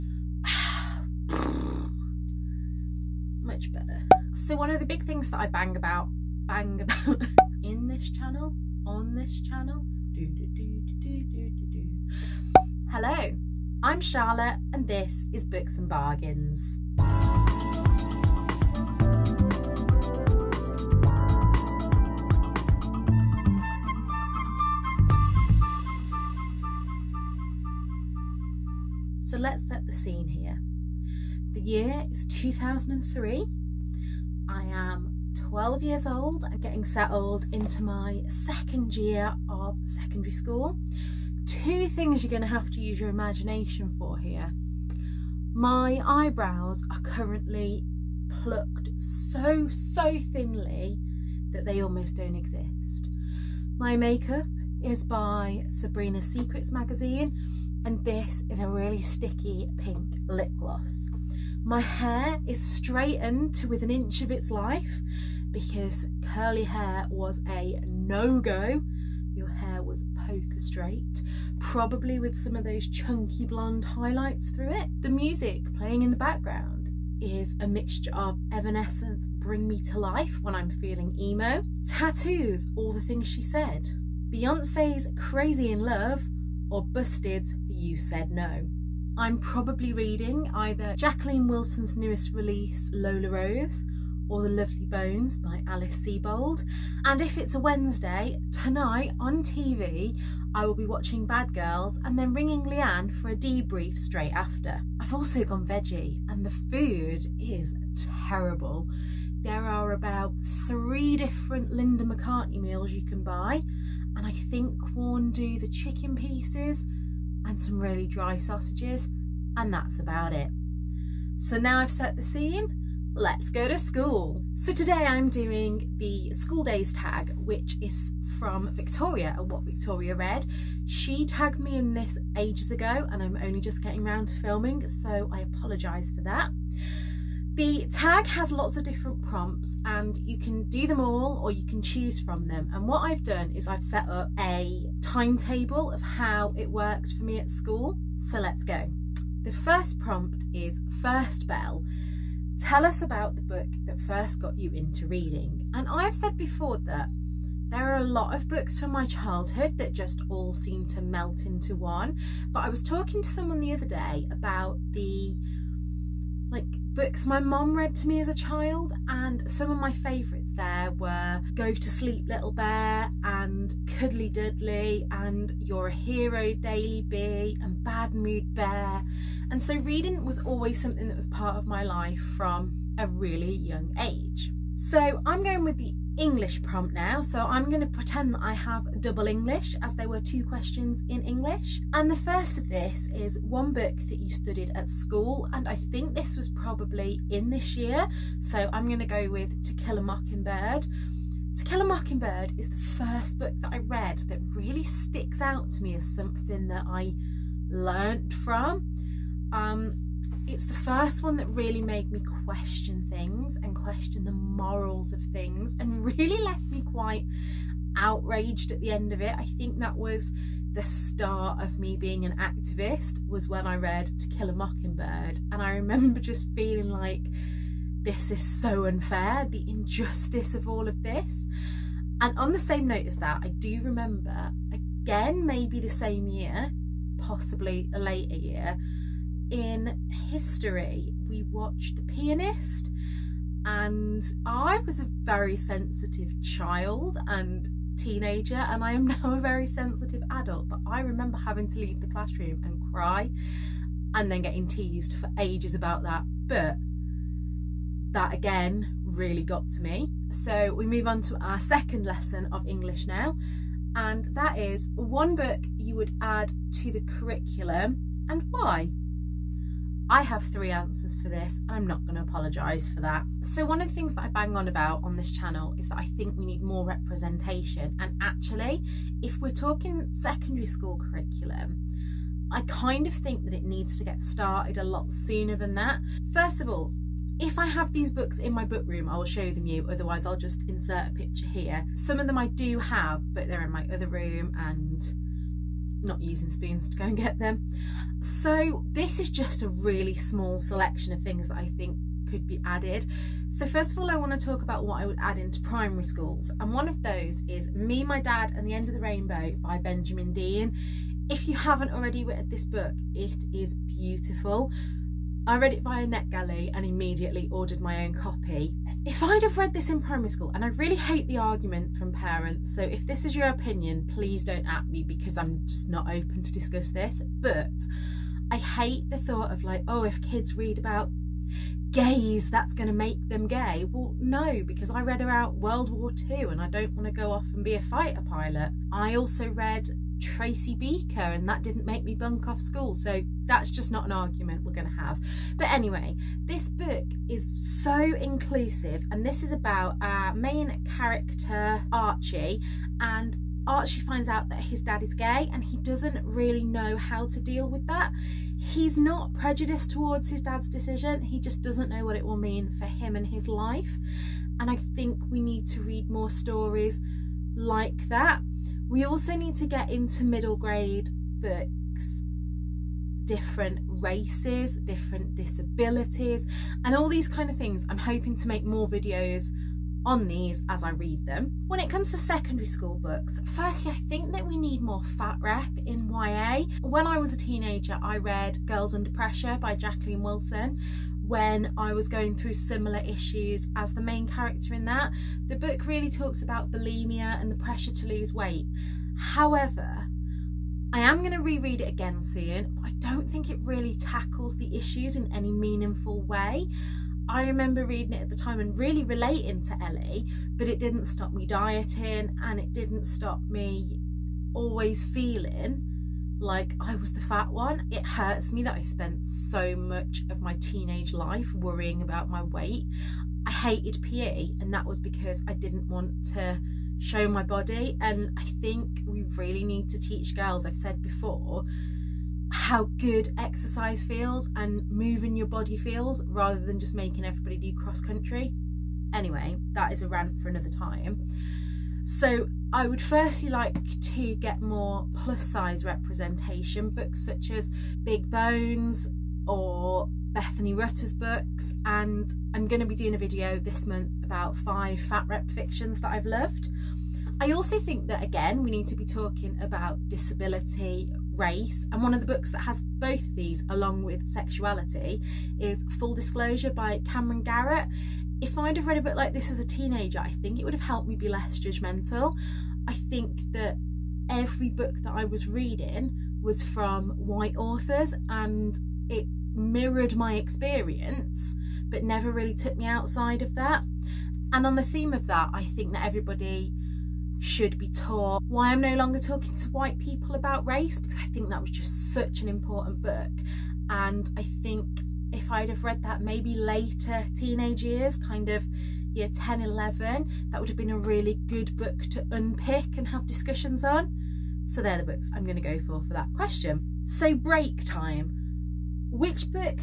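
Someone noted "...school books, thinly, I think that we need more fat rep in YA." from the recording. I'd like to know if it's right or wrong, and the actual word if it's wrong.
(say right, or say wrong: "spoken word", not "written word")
wrong: "firstly", not "thinly".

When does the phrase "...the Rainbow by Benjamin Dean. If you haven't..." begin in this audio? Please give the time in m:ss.
5:08.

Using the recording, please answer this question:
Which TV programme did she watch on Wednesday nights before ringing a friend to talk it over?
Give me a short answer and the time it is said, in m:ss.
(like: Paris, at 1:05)
Bad Girls, at 1:41.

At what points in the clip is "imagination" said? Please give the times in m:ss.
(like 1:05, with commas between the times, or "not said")
0:43.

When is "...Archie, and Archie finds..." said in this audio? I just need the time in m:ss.
5:51.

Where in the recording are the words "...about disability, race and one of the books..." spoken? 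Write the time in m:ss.
7:39.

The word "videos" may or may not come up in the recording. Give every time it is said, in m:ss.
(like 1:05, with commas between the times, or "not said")
6:18, 7:33.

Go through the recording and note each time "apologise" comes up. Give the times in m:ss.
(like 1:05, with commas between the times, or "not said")
2:15, 4:32.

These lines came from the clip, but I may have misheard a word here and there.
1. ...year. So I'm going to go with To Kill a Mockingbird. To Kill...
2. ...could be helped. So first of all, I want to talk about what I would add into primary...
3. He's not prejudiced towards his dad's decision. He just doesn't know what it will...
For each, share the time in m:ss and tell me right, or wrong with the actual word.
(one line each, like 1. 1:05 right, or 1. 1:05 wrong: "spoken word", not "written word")
1. 3:17 right
2. 5:02 wrong: "added", not "helped"
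3. 5:58 right.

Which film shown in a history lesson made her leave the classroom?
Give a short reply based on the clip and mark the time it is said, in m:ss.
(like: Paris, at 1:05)
The Pianist, at 4:01.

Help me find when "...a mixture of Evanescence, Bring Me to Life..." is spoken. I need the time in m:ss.
1:17.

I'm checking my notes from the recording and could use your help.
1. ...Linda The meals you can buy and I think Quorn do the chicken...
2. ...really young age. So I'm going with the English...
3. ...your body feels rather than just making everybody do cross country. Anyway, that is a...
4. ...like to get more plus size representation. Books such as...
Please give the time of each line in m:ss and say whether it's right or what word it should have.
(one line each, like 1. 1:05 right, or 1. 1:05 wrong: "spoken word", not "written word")
1. 1:51 wrong: "McCartney", not "The"
2. 3:03 right
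3. 7:15 right
4. 7:23 right.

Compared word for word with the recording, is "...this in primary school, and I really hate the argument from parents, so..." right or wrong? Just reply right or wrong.
right.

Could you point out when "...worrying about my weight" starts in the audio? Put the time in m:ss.
7:01.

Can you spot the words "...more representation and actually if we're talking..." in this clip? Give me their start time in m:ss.
4:36.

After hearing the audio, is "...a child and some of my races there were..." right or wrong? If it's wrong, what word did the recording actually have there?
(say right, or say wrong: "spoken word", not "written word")
wrong: "favourites", not "races".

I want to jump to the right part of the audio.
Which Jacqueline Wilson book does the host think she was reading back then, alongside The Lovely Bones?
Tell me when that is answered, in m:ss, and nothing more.
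1:32.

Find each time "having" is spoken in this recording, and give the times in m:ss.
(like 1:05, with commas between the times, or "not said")
4:11.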